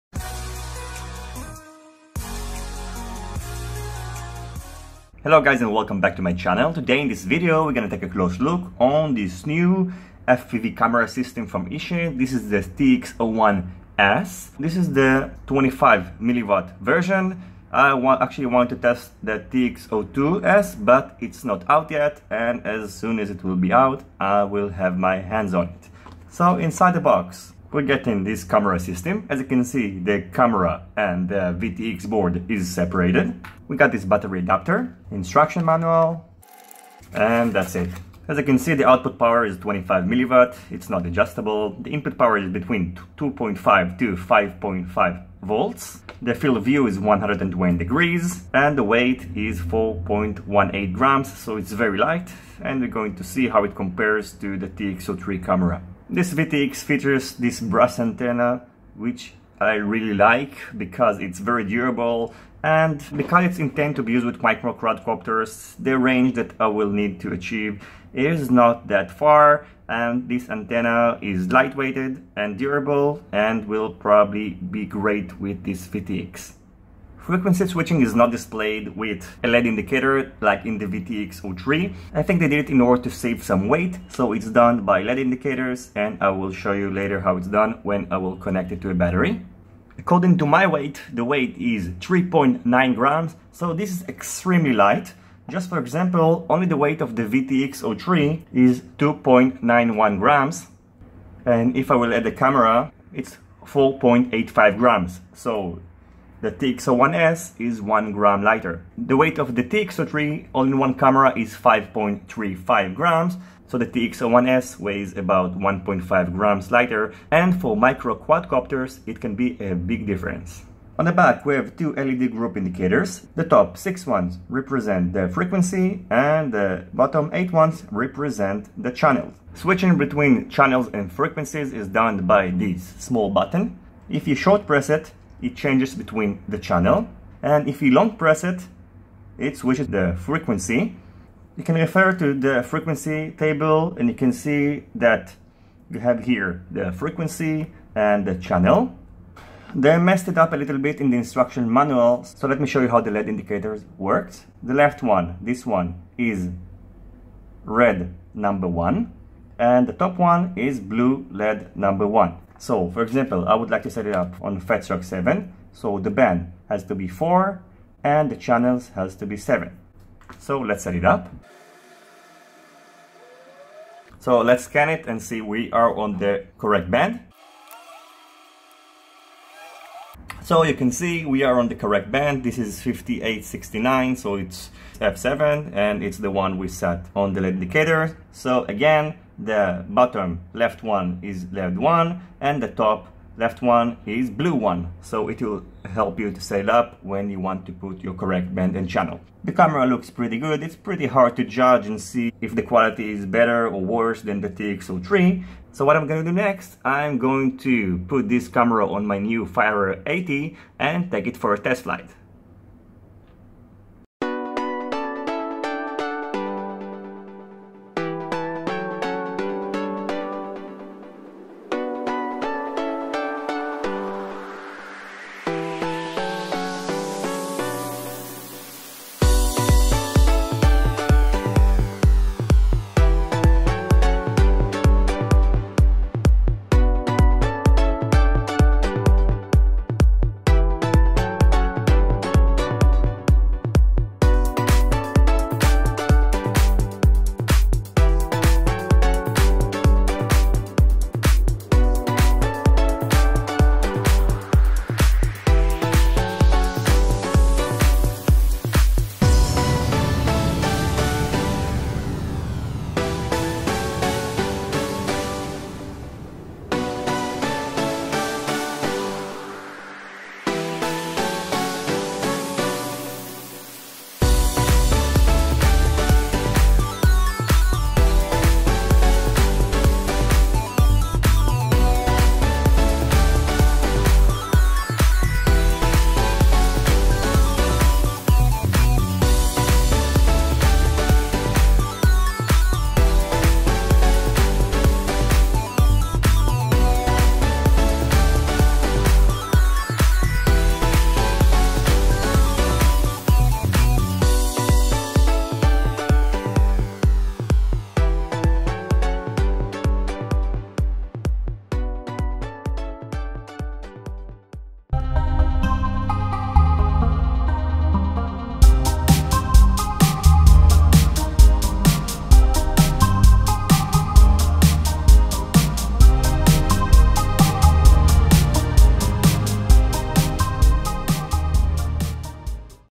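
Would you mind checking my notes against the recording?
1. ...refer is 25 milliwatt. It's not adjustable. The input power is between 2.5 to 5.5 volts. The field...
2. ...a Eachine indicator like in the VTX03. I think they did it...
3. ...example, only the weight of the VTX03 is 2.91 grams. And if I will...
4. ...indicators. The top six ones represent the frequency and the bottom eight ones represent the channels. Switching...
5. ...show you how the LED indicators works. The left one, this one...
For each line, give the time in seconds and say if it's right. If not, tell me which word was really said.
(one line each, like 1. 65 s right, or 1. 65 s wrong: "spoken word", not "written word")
1. 39 s wrong: "power", not "refer"
2. 79 s wrong: "LED", not "Eachine"
3. 95 s right
4. 122 s right
5. 152 s right.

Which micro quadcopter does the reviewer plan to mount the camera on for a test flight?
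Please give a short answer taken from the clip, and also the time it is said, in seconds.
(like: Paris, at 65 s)
Fire 80, at 209 s.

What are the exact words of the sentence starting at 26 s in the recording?
So inside the box we are getting this camera system.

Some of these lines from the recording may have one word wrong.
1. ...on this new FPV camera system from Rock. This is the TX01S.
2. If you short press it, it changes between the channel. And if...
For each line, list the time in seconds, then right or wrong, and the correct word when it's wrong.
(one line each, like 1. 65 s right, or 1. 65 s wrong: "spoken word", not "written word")
1. 8 s wrong: "Eachine", not "Rock"
2. 134 s right.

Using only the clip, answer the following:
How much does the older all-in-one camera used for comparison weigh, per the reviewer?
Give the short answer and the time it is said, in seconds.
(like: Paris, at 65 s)
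5.35 grams, at 111 s.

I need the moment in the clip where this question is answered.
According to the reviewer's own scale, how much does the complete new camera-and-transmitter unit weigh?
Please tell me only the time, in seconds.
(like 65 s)
91 s.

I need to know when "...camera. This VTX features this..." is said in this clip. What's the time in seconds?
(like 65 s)
55 s.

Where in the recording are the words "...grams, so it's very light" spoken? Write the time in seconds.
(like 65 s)
50 s.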